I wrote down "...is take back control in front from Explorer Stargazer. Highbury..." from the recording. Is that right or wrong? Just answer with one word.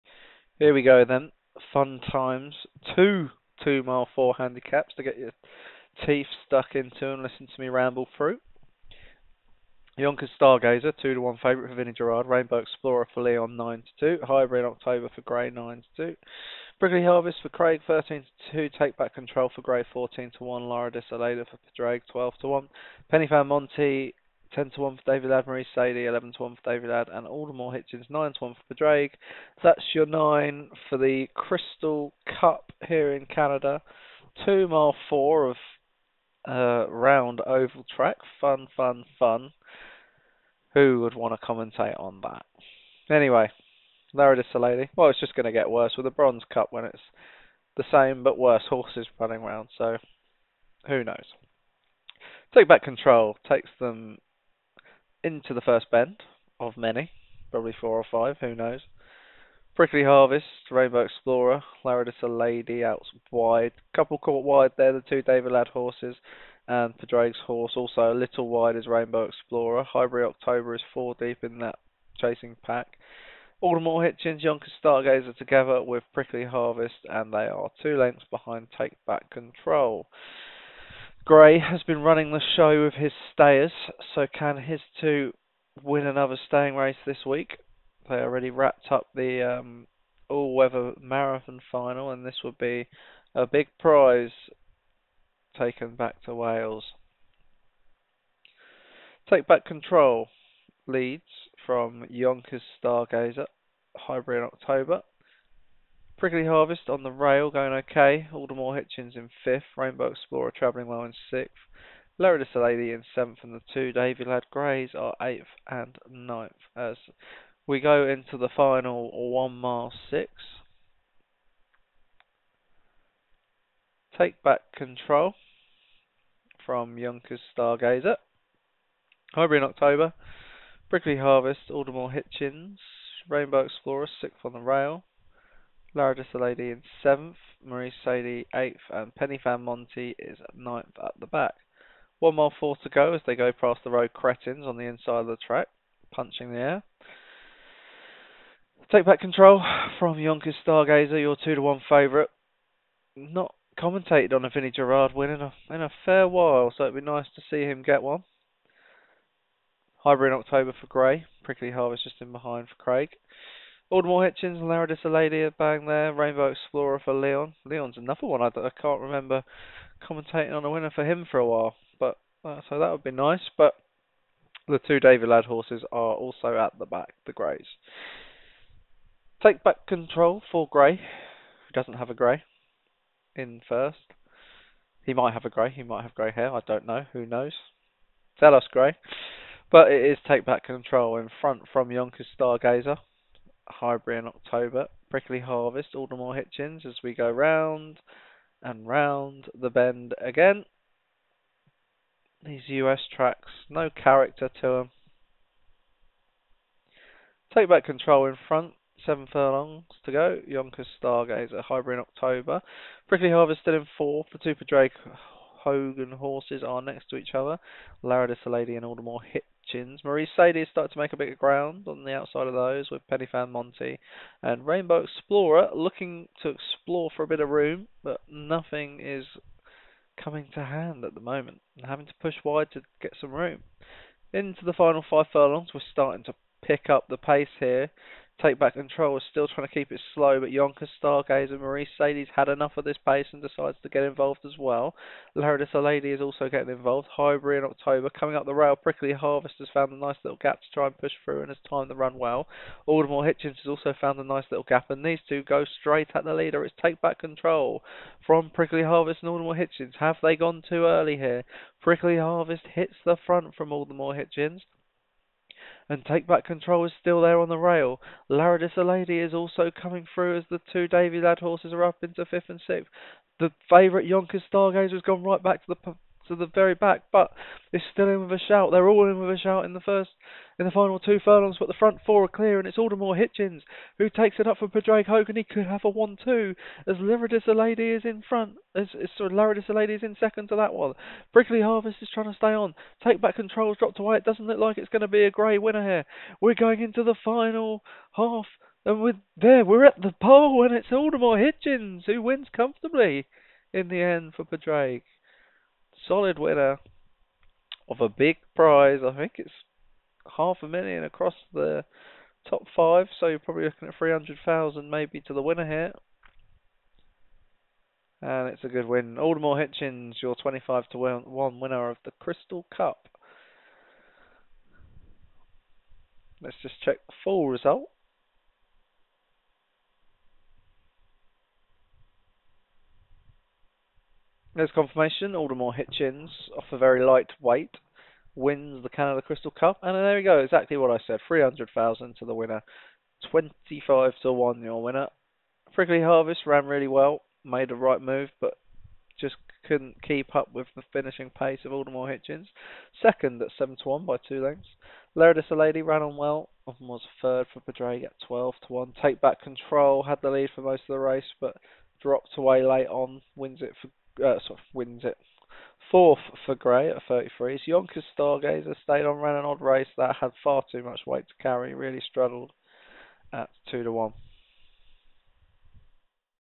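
wrong.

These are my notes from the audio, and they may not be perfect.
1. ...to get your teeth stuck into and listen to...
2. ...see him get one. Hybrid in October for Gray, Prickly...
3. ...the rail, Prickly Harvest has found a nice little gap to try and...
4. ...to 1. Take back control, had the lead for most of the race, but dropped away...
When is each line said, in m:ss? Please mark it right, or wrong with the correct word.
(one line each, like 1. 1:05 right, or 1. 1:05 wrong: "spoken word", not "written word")
1. 0:04 right
2. 2:37 right
3. 4:08 right
4. 5:58 right.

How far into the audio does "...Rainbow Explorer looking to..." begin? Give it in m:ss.
3:44.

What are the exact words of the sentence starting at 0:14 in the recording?
Hybrid October for Grey, nine to two.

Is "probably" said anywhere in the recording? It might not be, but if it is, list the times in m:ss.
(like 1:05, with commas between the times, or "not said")
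0:57, 5:13.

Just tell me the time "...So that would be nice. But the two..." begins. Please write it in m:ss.
2:52.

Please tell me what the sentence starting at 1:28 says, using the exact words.
They already wrapped up the um, all weather marathon final, and this would be a big prize taken back to Wales.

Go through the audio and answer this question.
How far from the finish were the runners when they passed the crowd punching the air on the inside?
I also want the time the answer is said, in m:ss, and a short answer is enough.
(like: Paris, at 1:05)
1 mile 4, at 2:22.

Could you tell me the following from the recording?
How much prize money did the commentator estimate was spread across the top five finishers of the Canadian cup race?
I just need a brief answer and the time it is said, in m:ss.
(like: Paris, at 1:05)
Half a million, at 5:10.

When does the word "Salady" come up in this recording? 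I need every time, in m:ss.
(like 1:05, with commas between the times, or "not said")
0:44, 1:52, 3:38.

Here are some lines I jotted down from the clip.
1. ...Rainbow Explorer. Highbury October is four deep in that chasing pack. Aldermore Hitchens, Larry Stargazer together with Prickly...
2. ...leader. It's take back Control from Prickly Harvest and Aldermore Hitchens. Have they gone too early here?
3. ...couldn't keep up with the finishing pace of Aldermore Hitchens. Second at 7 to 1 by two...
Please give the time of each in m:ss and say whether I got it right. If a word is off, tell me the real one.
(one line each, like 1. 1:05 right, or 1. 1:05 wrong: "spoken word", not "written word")
1. 1:08 wrong: "Yonkers", not "Larry"
2. 4:16 right
3. 5:49 right.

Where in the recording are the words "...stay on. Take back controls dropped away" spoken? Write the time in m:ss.
4:52.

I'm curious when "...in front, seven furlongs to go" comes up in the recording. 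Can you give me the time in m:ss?
3:28.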